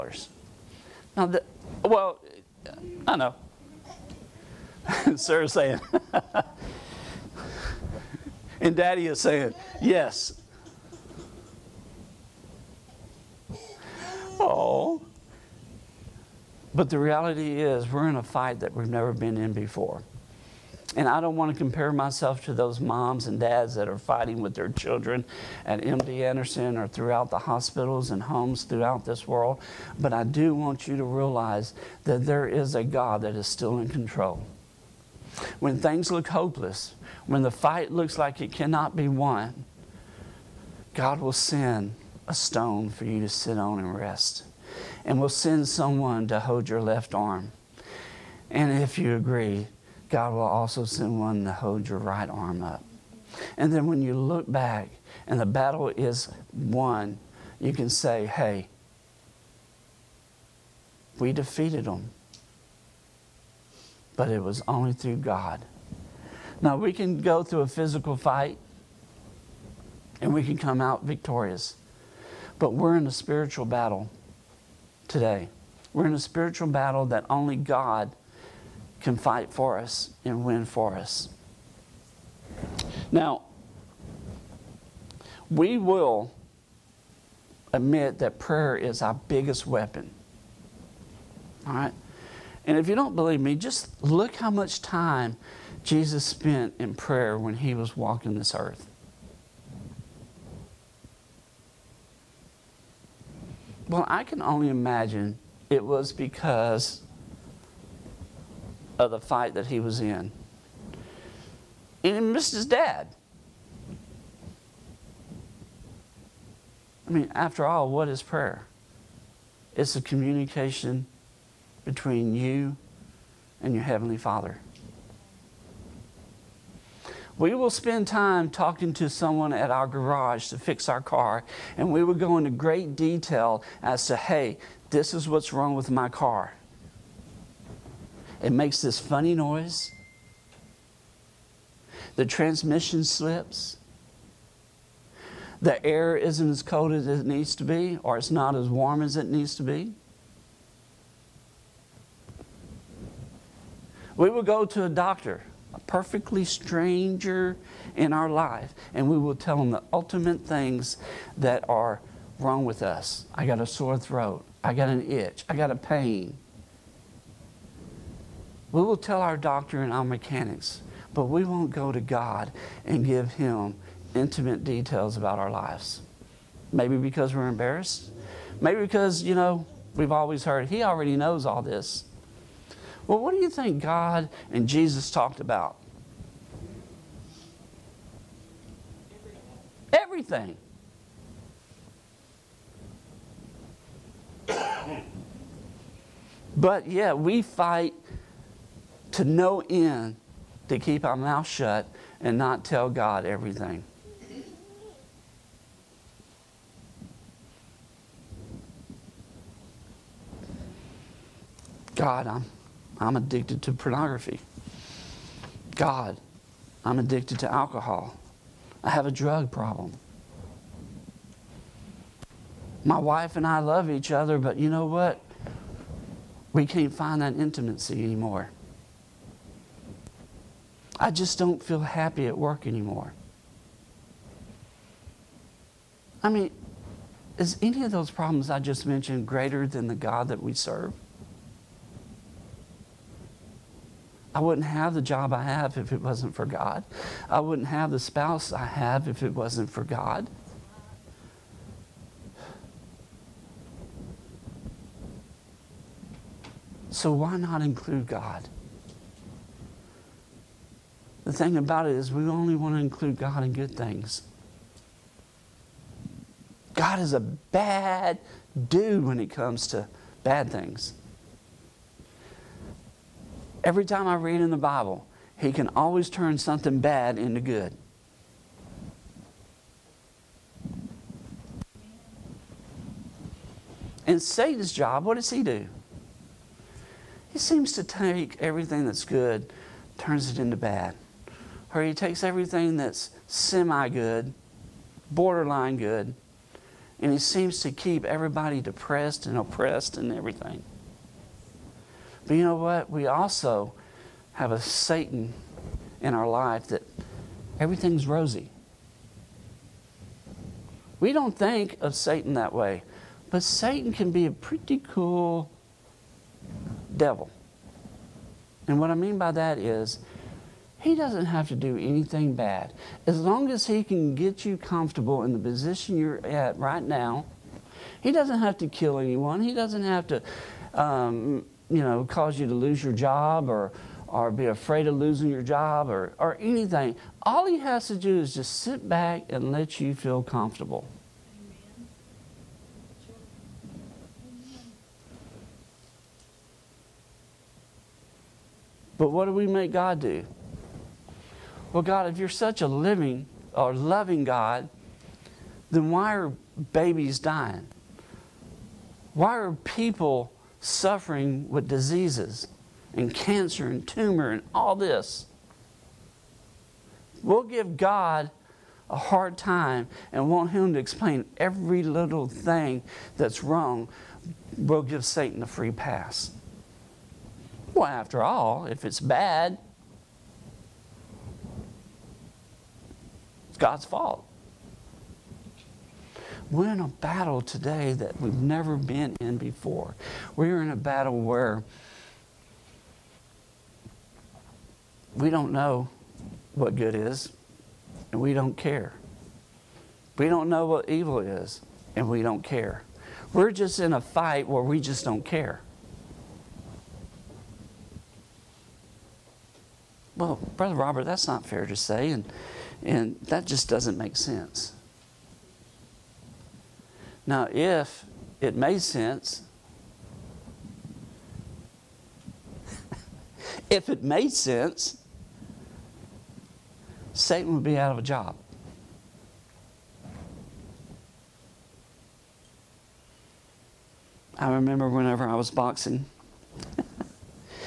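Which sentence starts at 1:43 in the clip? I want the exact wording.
Well, I can only imagine it was because of the fight that he was in.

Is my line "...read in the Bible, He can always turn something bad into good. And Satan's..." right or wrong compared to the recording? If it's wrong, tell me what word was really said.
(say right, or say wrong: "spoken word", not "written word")
right.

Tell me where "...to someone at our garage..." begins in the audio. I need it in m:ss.
2:08.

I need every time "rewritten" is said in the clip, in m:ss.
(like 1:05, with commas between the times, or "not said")
not said.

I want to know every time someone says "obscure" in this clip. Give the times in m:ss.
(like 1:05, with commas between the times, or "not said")
not said.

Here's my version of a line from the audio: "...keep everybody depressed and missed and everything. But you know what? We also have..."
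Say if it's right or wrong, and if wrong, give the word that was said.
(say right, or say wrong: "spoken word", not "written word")
wrong: "oppressed", not "missed".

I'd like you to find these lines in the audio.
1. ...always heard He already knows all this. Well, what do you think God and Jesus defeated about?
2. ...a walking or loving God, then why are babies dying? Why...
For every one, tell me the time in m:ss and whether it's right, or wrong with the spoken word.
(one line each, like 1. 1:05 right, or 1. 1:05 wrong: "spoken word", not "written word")
1. 3:00 wrong: "talked", not "defeated"
2. 5:52 wrong: "living", not "walking".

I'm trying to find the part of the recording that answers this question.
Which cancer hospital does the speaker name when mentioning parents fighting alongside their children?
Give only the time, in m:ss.
0:25.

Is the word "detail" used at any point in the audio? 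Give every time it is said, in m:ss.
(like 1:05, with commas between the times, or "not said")
2:12, 2:54.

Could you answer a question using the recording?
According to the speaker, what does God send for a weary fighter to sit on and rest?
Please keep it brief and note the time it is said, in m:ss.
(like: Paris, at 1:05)
A stone, at 0:42.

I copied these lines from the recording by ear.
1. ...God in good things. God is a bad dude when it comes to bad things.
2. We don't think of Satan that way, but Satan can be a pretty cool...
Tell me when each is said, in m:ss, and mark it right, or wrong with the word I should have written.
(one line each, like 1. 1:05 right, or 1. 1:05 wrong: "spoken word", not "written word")
1. 4:23 right
2. 5:10 right.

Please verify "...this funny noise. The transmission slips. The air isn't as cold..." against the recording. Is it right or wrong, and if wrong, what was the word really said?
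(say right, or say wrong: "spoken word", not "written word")
right.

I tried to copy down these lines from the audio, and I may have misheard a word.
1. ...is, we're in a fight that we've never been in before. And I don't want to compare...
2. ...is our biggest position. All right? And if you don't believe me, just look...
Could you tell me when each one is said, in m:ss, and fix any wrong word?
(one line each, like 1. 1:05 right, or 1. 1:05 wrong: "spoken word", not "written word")
1. 0:17 right
2. 1:28 wrong: "weapon", not "position".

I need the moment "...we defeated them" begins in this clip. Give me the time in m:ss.
1:01.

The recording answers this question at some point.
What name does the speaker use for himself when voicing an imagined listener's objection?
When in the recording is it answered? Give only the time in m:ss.
6:50.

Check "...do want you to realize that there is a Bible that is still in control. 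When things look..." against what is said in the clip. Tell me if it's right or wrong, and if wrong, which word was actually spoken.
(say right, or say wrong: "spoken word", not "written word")
wrong: "God", not "Bible".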